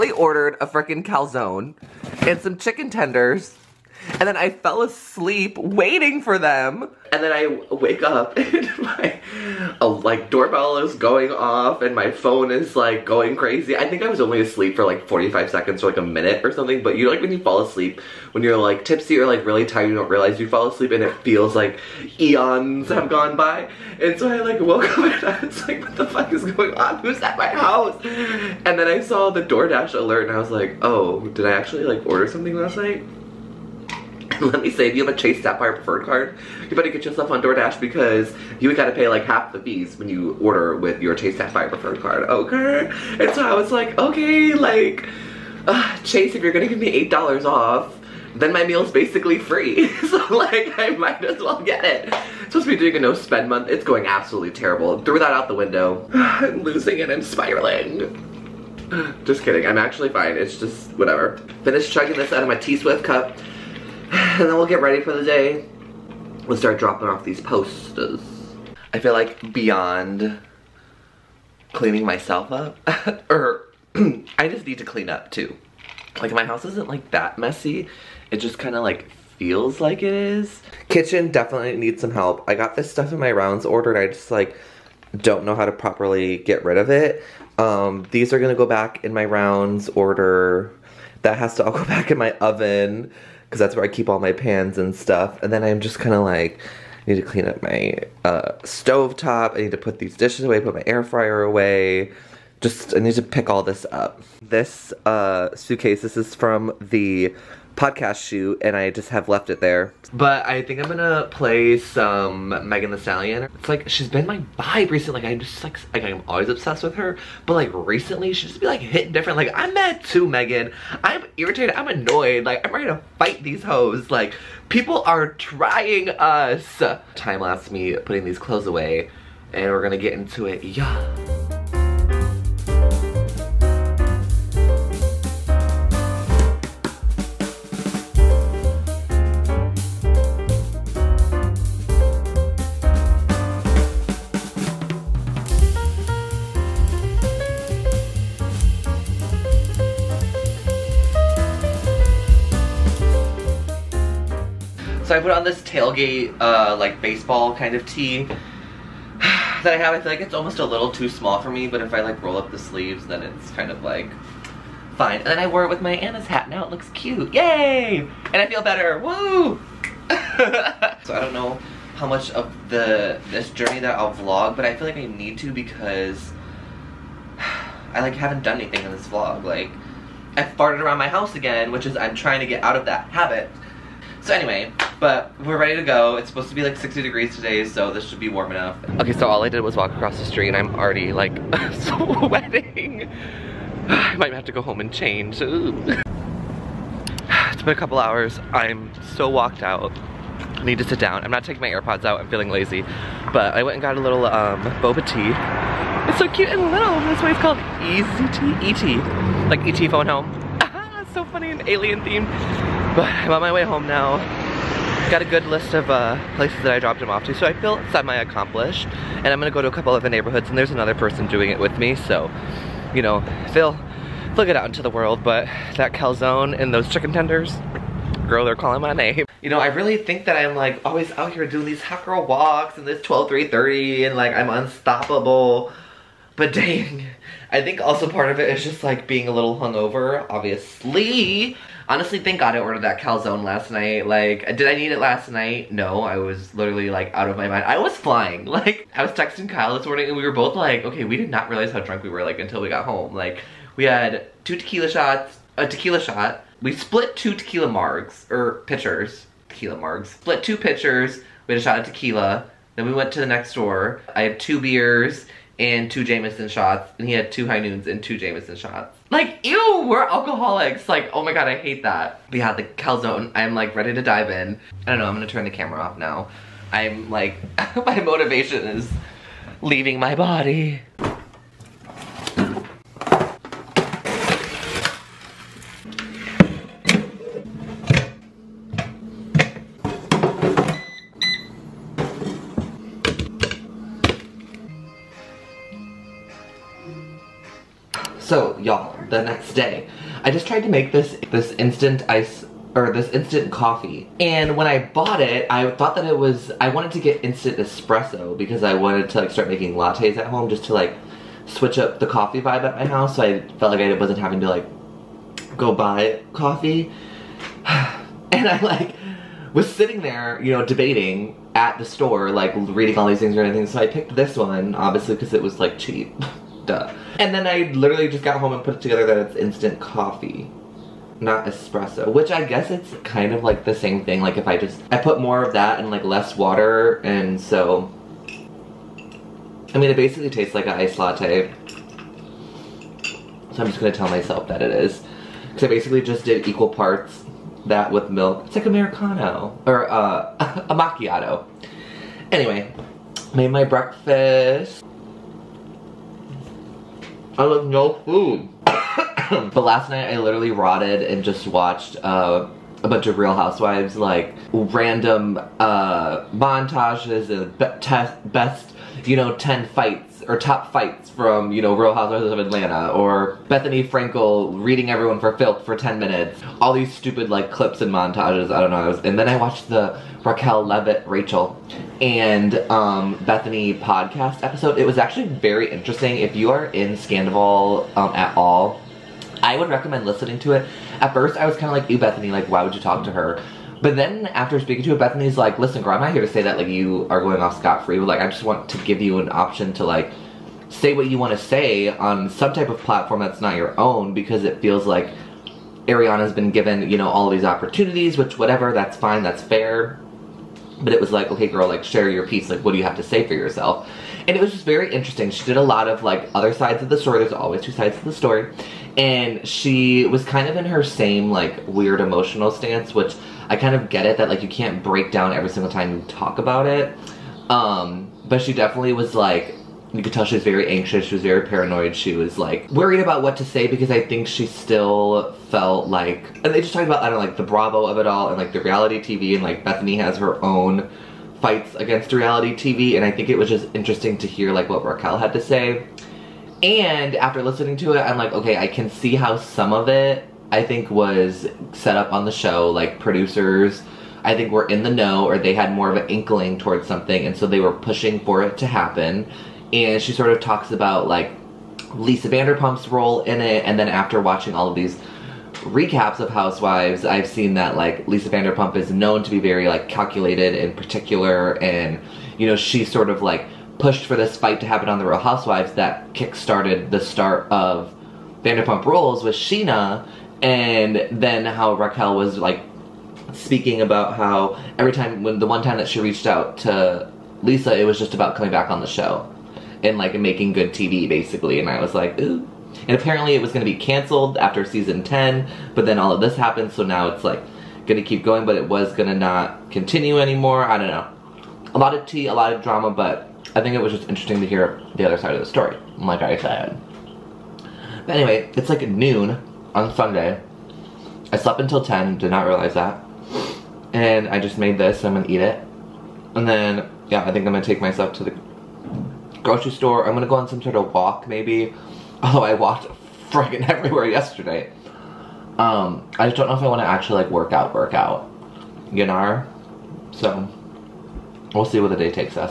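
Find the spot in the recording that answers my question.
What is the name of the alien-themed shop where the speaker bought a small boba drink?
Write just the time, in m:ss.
3:27.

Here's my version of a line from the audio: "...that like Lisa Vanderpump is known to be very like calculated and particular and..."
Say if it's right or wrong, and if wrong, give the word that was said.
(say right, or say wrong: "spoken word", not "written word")
right.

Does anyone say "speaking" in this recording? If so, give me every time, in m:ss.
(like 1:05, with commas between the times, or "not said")
6:34, 8:03.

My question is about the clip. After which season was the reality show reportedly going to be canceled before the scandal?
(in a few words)
10.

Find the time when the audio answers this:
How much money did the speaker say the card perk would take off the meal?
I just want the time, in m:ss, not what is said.
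0:47.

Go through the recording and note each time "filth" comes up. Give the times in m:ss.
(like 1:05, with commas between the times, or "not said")
6:15.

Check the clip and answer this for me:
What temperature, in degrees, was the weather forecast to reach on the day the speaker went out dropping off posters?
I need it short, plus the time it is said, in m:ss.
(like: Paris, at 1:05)
60, at 3:06.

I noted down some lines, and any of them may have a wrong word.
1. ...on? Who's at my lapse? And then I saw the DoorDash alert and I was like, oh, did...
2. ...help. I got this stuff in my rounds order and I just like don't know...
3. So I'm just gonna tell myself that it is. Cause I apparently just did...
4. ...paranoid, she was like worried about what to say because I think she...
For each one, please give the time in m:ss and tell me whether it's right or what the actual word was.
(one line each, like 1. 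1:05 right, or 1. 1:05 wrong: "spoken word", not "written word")
1. 0:26 wrong: "house", not "lapse"
2. 1:22 right
3. 5:43 wrong: "basically", not "apparently"
4. 7:11 right.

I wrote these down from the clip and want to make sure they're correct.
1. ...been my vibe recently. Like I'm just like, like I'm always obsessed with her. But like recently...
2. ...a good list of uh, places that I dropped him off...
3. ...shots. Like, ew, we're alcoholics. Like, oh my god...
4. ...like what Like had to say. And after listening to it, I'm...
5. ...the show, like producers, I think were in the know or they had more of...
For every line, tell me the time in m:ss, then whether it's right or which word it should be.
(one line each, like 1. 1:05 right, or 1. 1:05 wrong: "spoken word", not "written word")
1. 1:54 right
2. 3:35 right
3. 4:28 right
4. 7:24 wrong: "Raquel", not "Like"
5. 7:32 right.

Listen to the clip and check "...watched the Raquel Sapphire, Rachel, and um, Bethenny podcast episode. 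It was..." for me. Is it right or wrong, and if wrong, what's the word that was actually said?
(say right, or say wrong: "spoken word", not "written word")
wrong: "Leviss", not "Sapphire".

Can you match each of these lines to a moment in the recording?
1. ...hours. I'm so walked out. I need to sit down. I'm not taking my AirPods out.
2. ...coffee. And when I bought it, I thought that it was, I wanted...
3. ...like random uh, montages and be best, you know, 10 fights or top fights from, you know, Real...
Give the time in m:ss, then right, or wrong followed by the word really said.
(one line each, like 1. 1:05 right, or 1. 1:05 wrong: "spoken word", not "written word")
1. 3:17 right
2. 5:03 right
3. 6:03 right.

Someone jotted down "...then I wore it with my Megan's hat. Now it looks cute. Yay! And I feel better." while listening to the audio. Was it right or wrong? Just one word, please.
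wrong.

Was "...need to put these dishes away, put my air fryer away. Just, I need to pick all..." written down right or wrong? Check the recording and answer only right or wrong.
right.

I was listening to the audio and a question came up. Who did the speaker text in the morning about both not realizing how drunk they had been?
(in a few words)
Kyle.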